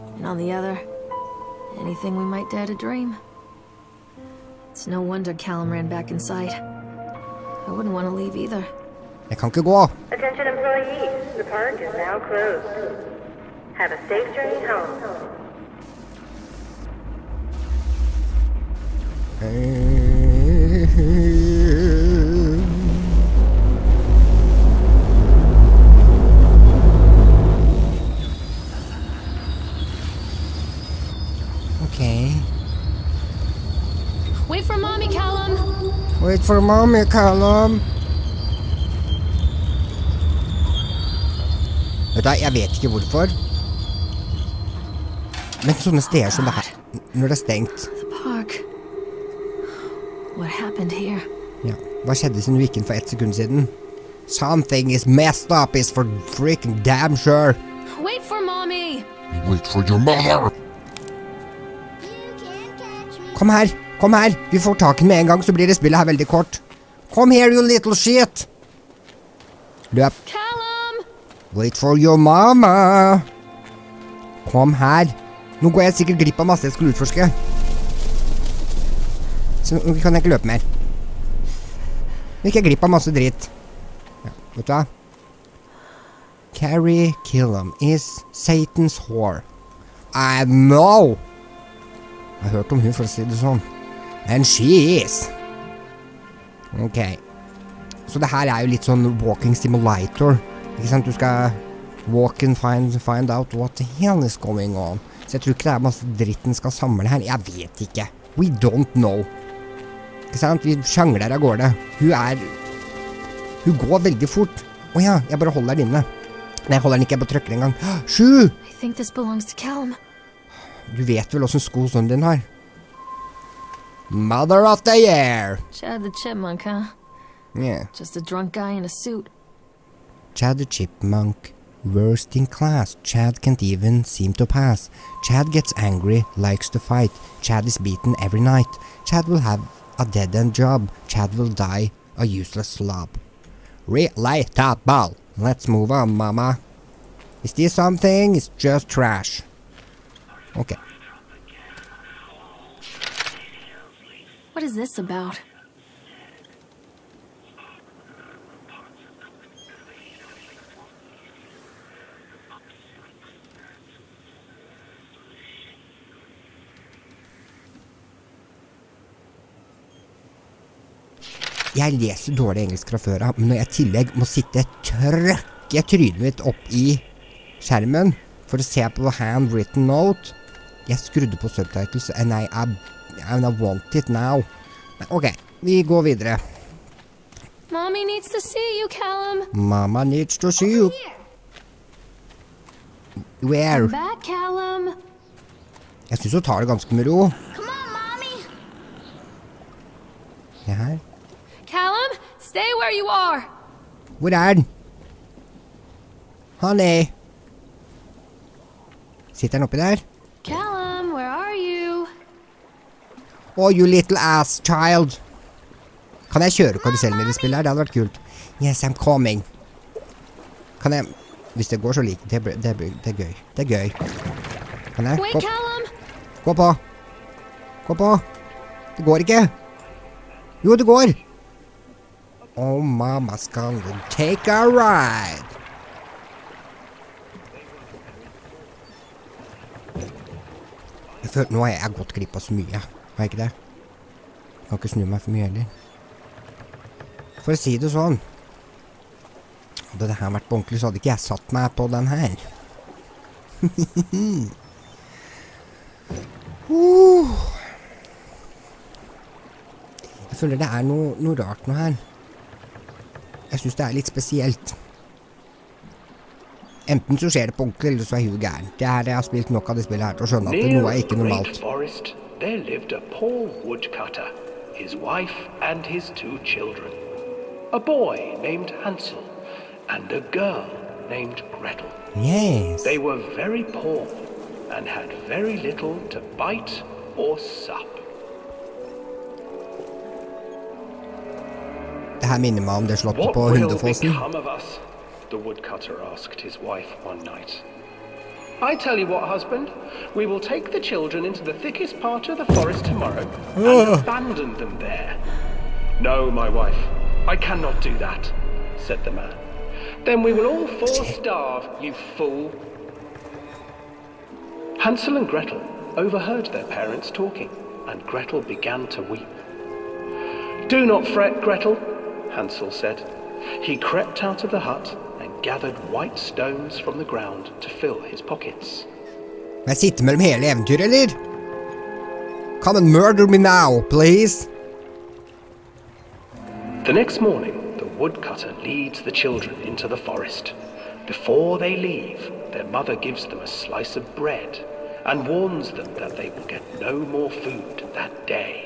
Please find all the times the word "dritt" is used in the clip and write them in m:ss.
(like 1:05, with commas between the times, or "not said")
1:23, 1:46.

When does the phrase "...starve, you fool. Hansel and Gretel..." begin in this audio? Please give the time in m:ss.
5:11.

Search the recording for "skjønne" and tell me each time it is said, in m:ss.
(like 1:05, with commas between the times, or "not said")
4:30.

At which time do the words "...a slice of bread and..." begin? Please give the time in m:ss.
5:43.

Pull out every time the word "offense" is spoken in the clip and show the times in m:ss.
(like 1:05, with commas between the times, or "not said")
not said.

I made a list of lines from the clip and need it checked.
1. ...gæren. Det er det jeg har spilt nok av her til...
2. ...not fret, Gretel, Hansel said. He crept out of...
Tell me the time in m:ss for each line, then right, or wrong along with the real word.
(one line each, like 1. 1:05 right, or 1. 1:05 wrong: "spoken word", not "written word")
1. 4:28 right
2. 5:20 right.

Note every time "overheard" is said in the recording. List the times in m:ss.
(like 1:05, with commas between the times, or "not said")
5:15.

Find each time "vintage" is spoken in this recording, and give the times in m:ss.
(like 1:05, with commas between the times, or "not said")
not said.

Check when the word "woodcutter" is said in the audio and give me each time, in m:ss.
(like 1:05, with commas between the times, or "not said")
4:33, 4:55, 5:37.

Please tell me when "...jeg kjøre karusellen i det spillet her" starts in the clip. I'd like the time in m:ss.
3:36.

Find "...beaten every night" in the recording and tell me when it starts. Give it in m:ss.
2:17.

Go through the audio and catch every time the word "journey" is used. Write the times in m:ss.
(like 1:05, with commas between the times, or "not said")
0:14.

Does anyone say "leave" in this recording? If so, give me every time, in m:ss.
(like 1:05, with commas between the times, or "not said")
0:08, 5:41.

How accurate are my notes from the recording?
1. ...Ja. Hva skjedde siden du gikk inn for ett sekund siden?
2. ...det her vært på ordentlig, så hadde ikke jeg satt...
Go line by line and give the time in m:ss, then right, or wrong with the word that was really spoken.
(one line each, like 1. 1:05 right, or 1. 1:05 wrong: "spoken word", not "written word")
1. 0:51 right
2. 4:10 right.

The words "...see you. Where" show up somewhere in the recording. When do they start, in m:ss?
3:10.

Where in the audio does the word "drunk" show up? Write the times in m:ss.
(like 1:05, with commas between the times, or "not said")
2:08.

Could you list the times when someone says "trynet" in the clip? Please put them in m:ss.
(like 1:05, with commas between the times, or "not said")
2:55.